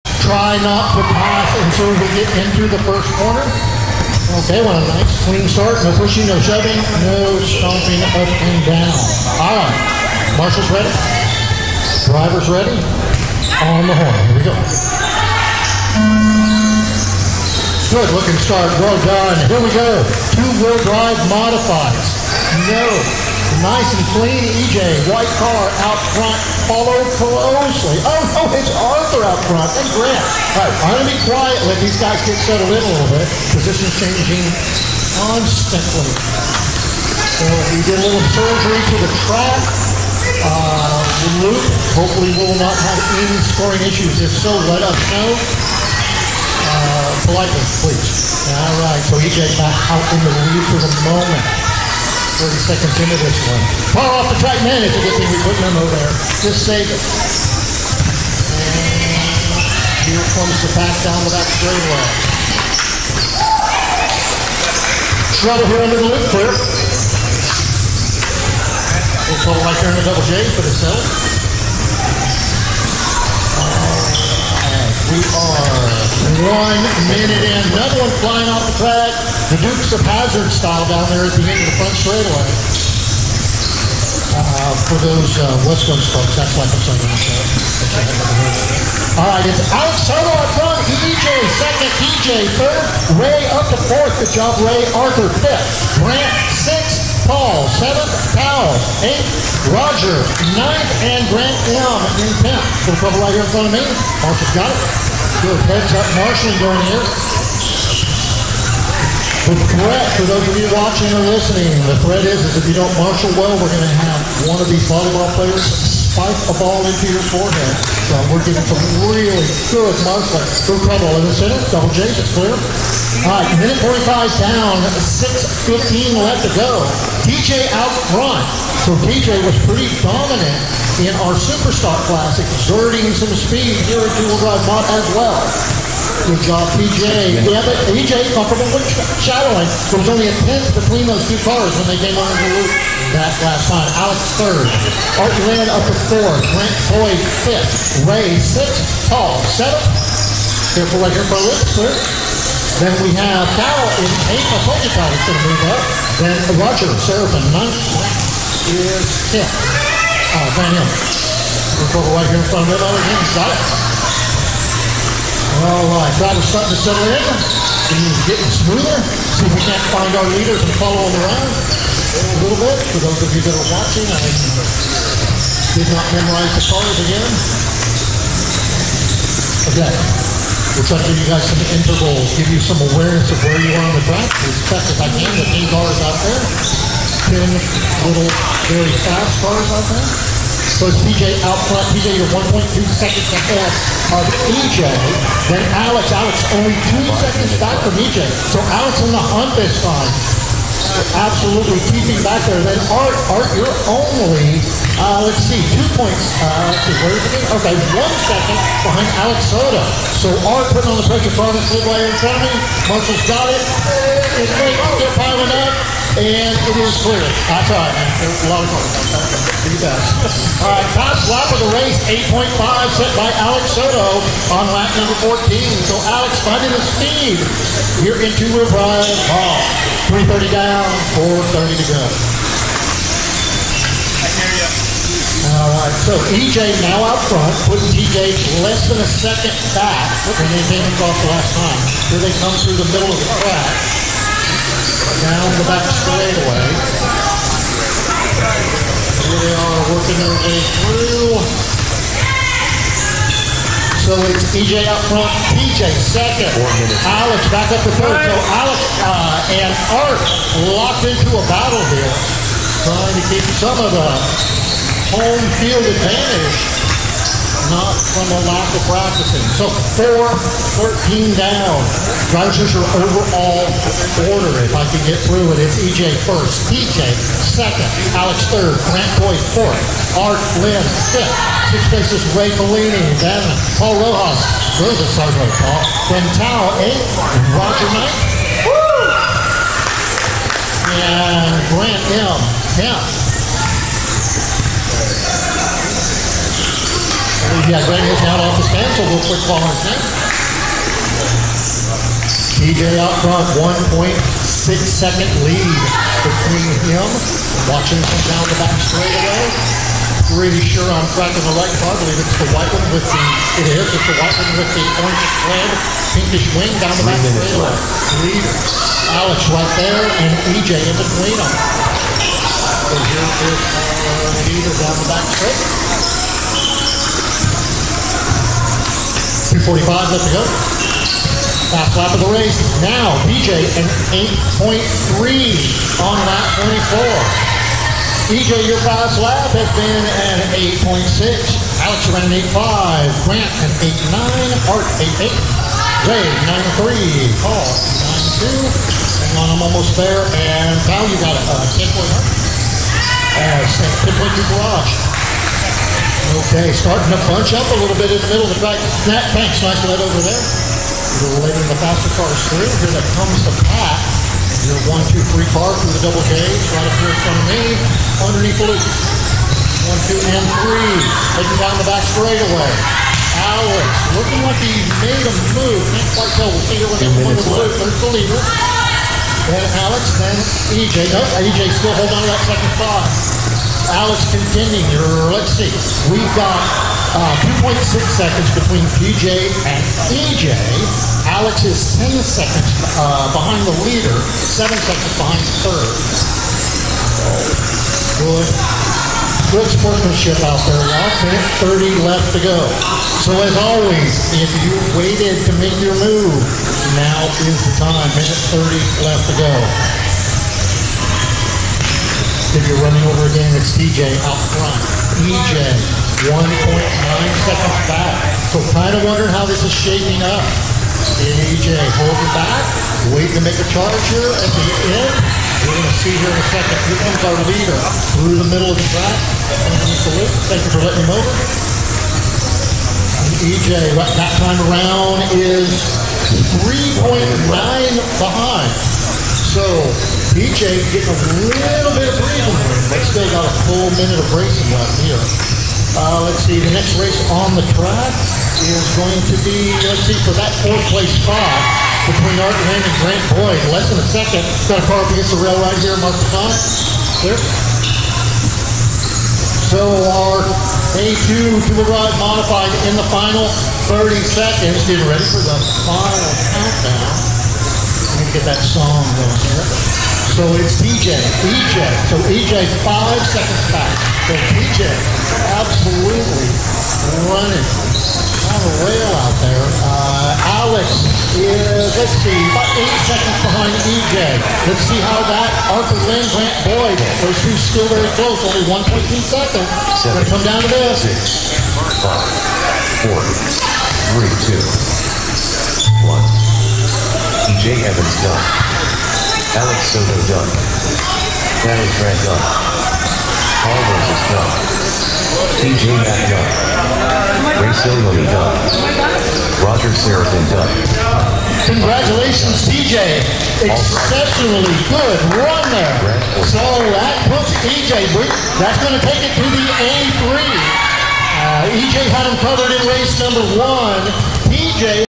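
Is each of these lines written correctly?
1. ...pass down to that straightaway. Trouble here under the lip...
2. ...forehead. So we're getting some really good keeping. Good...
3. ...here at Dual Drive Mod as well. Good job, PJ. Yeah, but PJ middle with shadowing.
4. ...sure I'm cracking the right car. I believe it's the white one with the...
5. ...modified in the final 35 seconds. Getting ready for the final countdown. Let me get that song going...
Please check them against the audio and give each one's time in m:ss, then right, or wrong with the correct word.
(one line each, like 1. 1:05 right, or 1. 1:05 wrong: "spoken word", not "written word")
1. 1:00 right
2. 1:57 wrong: "marshaling", not "keeping"
3. 2:13 wrong: "comfortable", not "middle"
4. 5:10 right
5. 7:42 wrong: "30", not "35".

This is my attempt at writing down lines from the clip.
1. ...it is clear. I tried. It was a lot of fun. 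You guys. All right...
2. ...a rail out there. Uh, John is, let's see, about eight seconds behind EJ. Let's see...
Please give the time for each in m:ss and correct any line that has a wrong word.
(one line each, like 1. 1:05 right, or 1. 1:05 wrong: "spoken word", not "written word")
1. 3:36 right
2. 7:58 wrong: "Alex", not "John".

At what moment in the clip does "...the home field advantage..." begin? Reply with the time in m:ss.
4:23.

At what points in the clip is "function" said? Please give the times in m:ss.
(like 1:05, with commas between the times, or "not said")
not said.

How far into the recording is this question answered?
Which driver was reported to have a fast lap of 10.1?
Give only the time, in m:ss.
5:50.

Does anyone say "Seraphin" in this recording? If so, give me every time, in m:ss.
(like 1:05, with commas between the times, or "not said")
2:37, 8:29.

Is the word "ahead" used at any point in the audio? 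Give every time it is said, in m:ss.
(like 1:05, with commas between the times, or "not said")
3:13.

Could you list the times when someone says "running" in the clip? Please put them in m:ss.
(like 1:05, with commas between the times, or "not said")
6:52, 7:57.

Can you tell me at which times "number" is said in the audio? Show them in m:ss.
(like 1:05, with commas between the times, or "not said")
3:44, 8:43.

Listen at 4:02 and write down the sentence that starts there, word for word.
Here they come through the middle of the track, down the back straightaway.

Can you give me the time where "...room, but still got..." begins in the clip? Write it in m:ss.
7:22.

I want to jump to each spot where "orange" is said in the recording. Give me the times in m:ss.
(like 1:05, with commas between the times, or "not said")
5:15.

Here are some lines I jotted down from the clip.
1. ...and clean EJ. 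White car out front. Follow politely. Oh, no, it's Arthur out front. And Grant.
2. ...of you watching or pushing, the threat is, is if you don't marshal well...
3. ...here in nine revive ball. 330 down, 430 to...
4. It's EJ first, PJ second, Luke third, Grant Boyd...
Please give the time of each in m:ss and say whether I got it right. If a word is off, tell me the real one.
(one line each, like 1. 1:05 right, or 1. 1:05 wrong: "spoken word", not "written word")
1. 0:23 wrong: "closely", not "politely"
2. 1:50 wrong: "listening", not "pushing"
3. 3:48 wrong: "two", not "nine"
4. 4:35 wrong: "Alex", not "Luke".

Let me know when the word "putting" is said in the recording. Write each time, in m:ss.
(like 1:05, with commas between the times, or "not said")
3:30, 3:57.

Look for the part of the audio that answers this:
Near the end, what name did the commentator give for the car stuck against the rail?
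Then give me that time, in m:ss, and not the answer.
7:35.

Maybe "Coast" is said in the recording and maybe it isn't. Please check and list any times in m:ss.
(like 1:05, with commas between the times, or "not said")
1:25.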